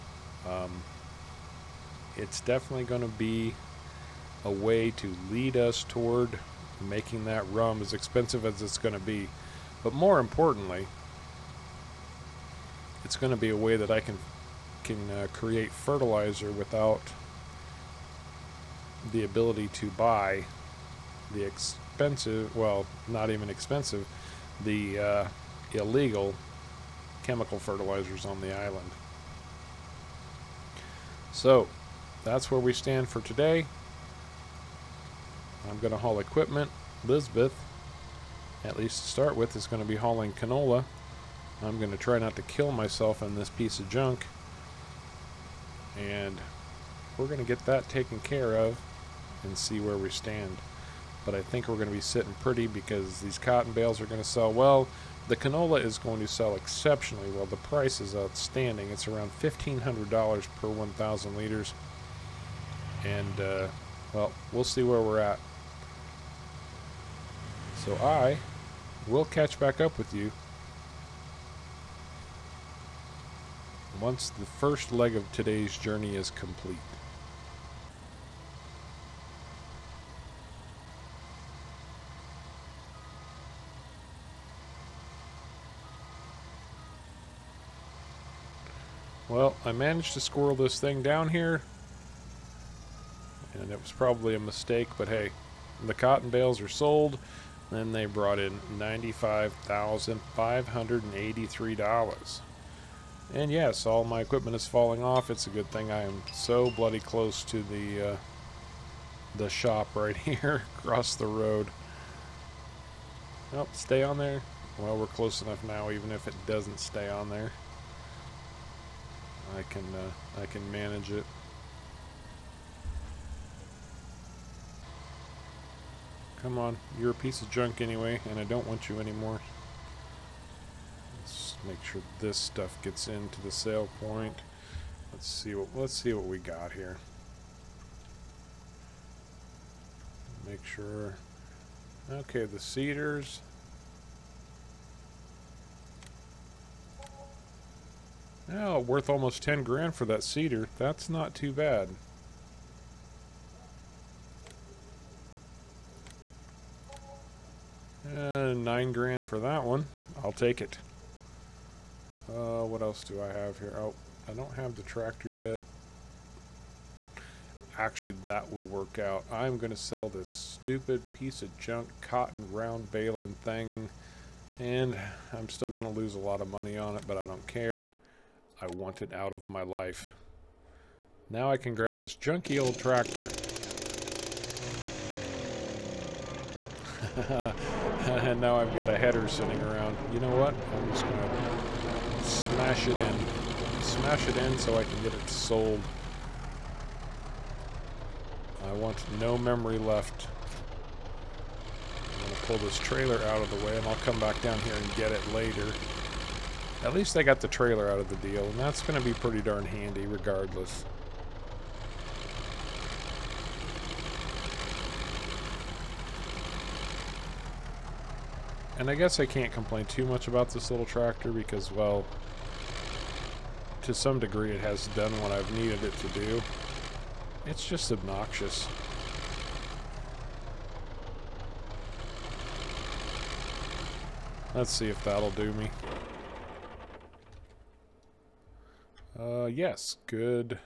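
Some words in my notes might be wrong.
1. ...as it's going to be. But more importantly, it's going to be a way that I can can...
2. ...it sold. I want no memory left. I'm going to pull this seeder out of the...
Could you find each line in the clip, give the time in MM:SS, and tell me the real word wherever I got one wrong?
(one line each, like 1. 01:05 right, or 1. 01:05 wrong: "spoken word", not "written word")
1. 00:08 right
2. 03:15 wrong: "trailer", not "seeder".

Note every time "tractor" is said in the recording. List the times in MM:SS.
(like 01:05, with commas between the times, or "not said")
02:44, 03:02, 03:40.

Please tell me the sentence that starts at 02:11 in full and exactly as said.
Let's make sure this stuff gets into the sale point.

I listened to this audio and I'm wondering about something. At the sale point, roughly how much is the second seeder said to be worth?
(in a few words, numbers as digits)
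9 grand.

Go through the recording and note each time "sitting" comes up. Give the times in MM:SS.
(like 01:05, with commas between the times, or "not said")
00:51, 03:09.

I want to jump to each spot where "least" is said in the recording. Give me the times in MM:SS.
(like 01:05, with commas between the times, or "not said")
00:38, 03:26.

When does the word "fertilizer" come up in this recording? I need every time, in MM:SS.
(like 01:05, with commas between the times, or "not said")
00:15, 00:27.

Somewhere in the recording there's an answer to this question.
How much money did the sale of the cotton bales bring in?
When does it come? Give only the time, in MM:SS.
01:38.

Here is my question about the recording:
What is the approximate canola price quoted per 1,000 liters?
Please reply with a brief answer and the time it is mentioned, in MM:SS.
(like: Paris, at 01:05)
$1,500, at 00:59.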